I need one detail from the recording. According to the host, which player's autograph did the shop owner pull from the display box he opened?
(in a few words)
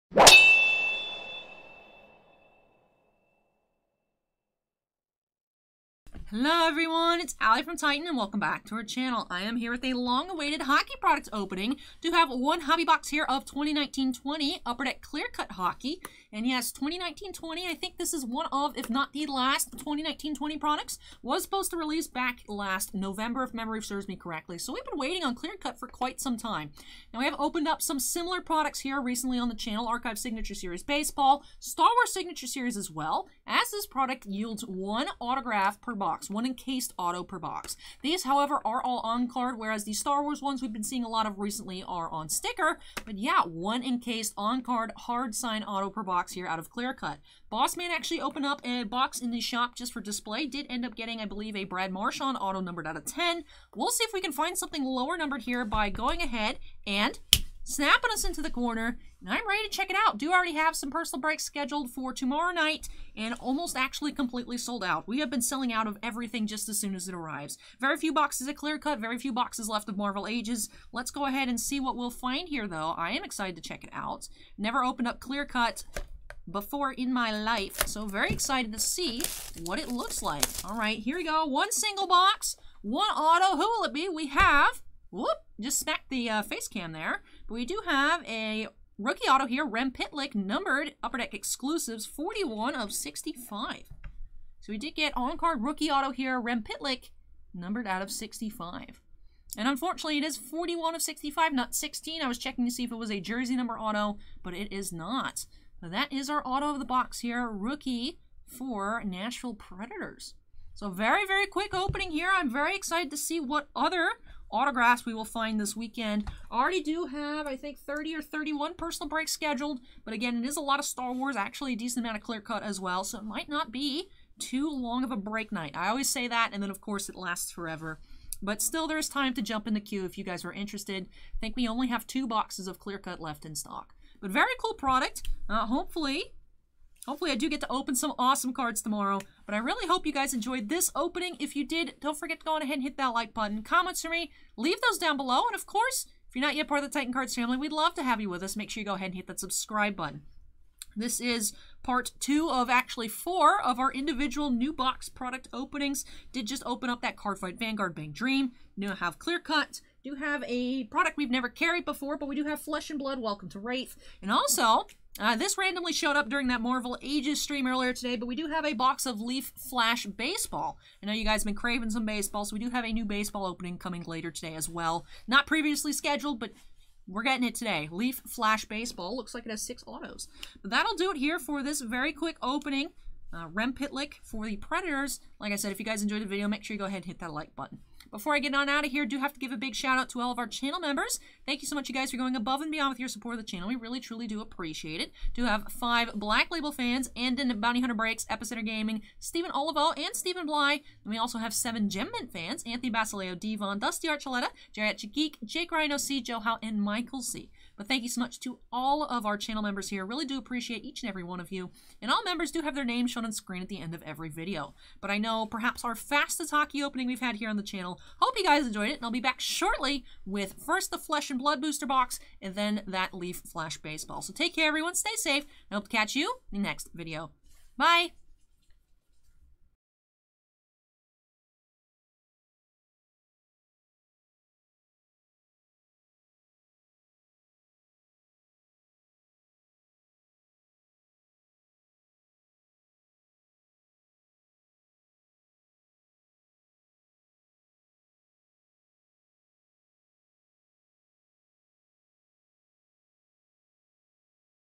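Brad Marchand.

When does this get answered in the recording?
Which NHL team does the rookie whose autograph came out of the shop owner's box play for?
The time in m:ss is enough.
1:49.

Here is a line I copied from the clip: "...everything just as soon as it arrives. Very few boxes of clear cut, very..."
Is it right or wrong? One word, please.
right.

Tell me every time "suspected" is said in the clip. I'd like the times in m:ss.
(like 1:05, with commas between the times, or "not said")
not said.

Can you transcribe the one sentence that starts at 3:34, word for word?
But I know perhaps our fastest hockey opening we've had here on the channel channel.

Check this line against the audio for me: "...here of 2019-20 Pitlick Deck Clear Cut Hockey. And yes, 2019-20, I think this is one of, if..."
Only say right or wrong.
wrong.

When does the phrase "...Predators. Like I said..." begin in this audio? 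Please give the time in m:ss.
3:04.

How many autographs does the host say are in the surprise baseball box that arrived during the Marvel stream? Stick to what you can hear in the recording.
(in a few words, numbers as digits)
6.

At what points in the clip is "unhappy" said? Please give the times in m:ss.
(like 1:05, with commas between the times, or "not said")
not said.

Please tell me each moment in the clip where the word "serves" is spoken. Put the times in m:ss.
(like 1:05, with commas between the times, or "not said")
0:23.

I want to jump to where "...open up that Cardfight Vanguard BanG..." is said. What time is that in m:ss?
2:36.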